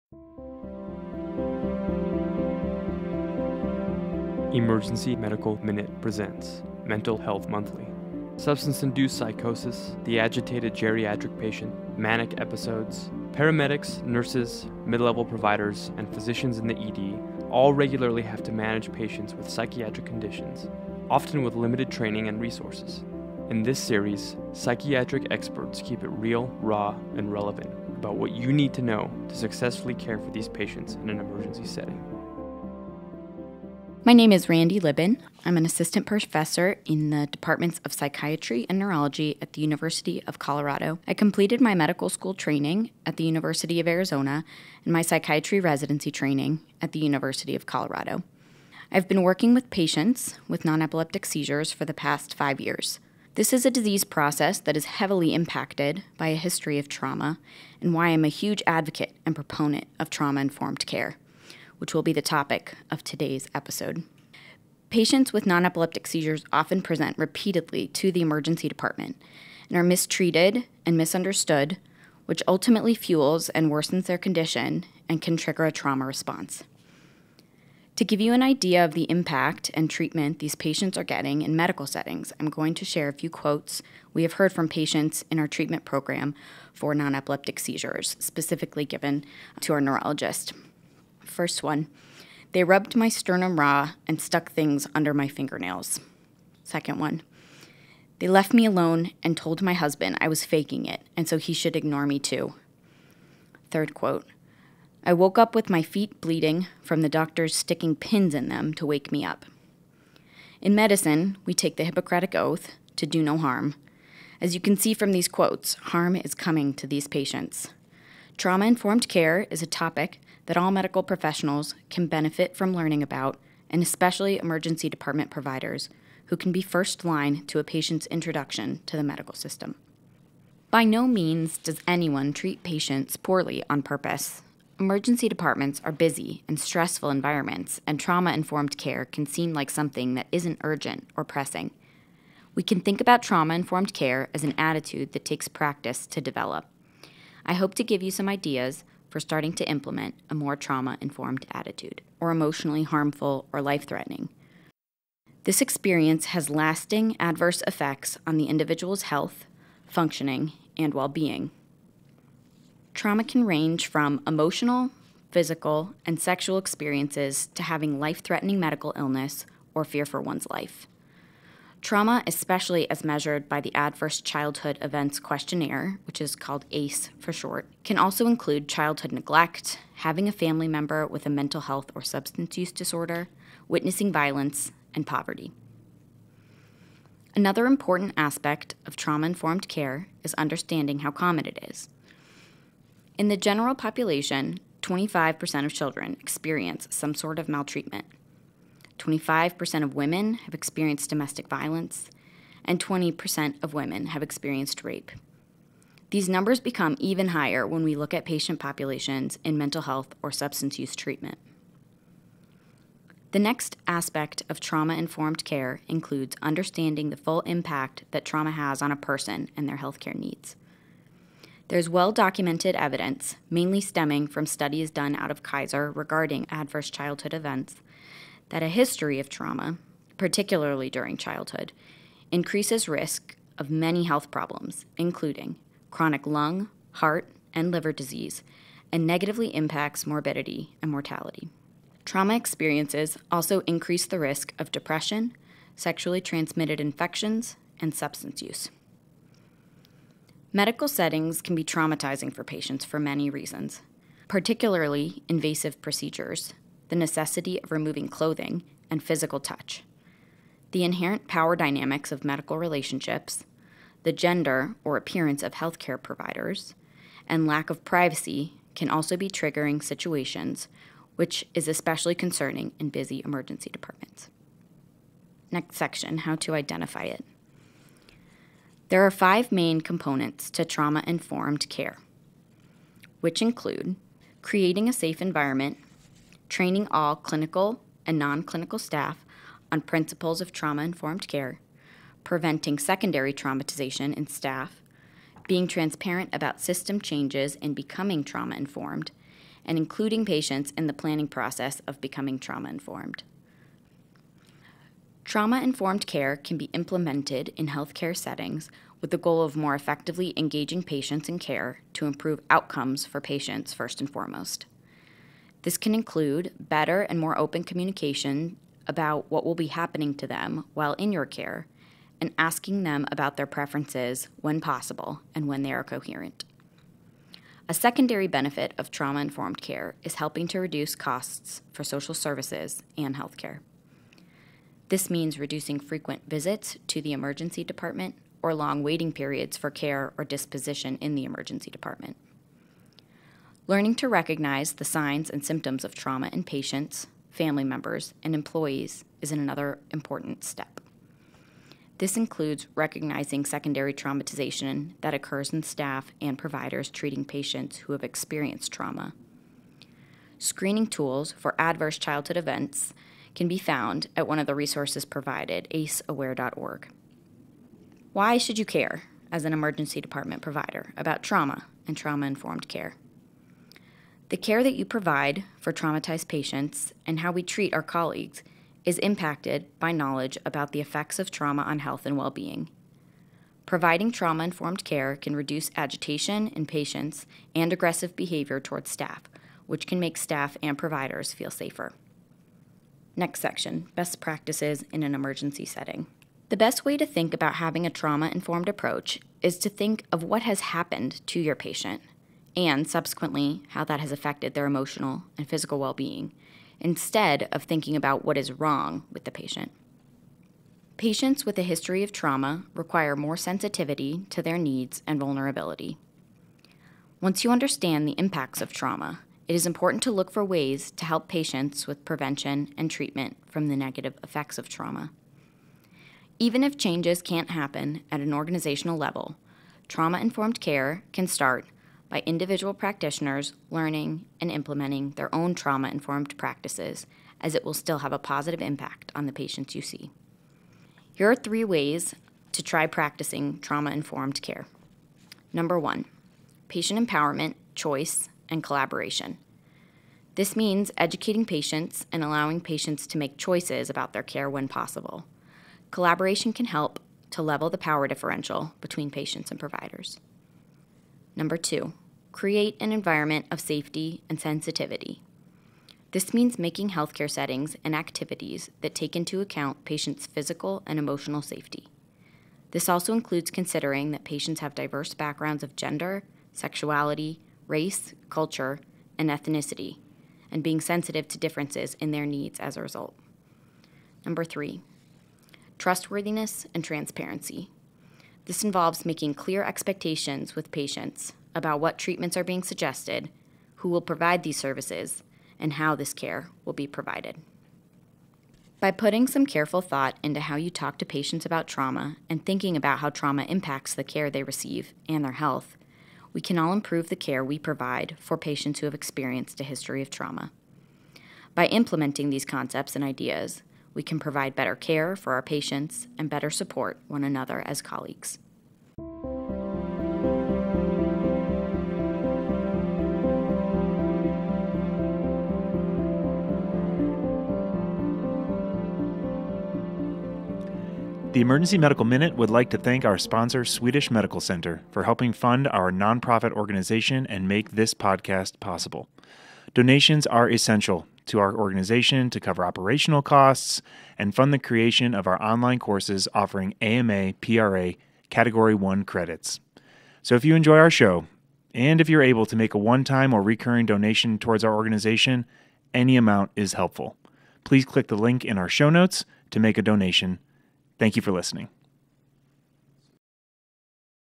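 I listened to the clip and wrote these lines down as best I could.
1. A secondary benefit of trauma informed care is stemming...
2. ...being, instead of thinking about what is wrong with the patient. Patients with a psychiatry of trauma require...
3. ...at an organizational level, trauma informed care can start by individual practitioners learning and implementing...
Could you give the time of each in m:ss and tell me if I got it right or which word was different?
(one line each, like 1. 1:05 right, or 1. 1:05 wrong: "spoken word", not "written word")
1. 5:27 wrong: "helping", not "stemming"
2. 6:45 wrong: "history", not "psychiatry"
3. 7:08 right.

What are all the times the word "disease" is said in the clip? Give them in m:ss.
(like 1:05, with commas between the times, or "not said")
0:53, 3:57.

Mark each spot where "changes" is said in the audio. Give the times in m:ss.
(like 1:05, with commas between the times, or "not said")
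4:56, 7:06.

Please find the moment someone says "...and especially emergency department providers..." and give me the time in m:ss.
2:03.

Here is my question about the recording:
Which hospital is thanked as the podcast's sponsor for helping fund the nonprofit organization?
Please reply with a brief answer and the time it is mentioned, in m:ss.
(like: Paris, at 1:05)
Swedish Medical Center, at 8:53.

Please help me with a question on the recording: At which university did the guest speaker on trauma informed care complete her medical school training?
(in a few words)
University of Arizona.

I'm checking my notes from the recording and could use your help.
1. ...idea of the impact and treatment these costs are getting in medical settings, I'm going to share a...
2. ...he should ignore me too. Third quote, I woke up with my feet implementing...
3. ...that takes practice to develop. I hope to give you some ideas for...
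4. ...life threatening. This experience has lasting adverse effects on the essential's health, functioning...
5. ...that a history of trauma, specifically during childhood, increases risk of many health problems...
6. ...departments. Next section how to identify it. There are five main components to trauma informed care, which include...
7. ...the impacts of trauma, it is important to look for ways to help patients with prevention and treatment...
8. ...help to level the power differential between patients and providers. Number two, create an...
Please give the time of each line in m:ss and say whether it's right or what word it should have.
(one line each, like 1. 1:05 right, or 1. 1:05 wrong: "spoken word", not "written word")
1. 1:18 wrong: "patients", not "costs"
2. 1:41 wrong: "bleeding", not "implementing"
3. 2:25 right
4. 2:33 wrong: "individual", not "essential"
5. 3:48 wrong: "particularly", not "specifically"
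6. 4:33 right
7. 6:58 right
8. 7:36 right.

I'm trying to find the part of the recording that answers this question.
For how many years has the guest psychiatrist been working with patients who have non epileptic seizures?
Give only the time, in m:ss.
0:52.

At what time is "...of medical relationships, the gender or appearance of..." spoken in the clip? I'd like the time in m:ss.
4:22.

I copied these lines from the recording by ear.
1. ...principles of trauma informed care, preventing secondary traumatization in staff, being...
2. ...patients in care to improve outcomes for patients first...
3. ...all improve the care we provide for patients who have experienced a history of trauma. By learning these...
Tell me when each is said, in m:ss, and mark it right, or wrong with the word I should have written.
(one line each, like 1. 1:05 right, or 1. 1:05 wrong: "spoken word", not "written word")
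1. 4:49 right
2. 5:10 right
3. 8:26 wrong: "implementing", not "learning".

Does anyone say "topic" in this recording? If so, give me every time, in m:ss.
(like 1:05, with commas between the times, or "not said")
1:02, 1:59.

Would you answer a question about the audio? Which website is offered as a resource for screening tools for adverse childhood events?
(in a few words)
acesaware.org.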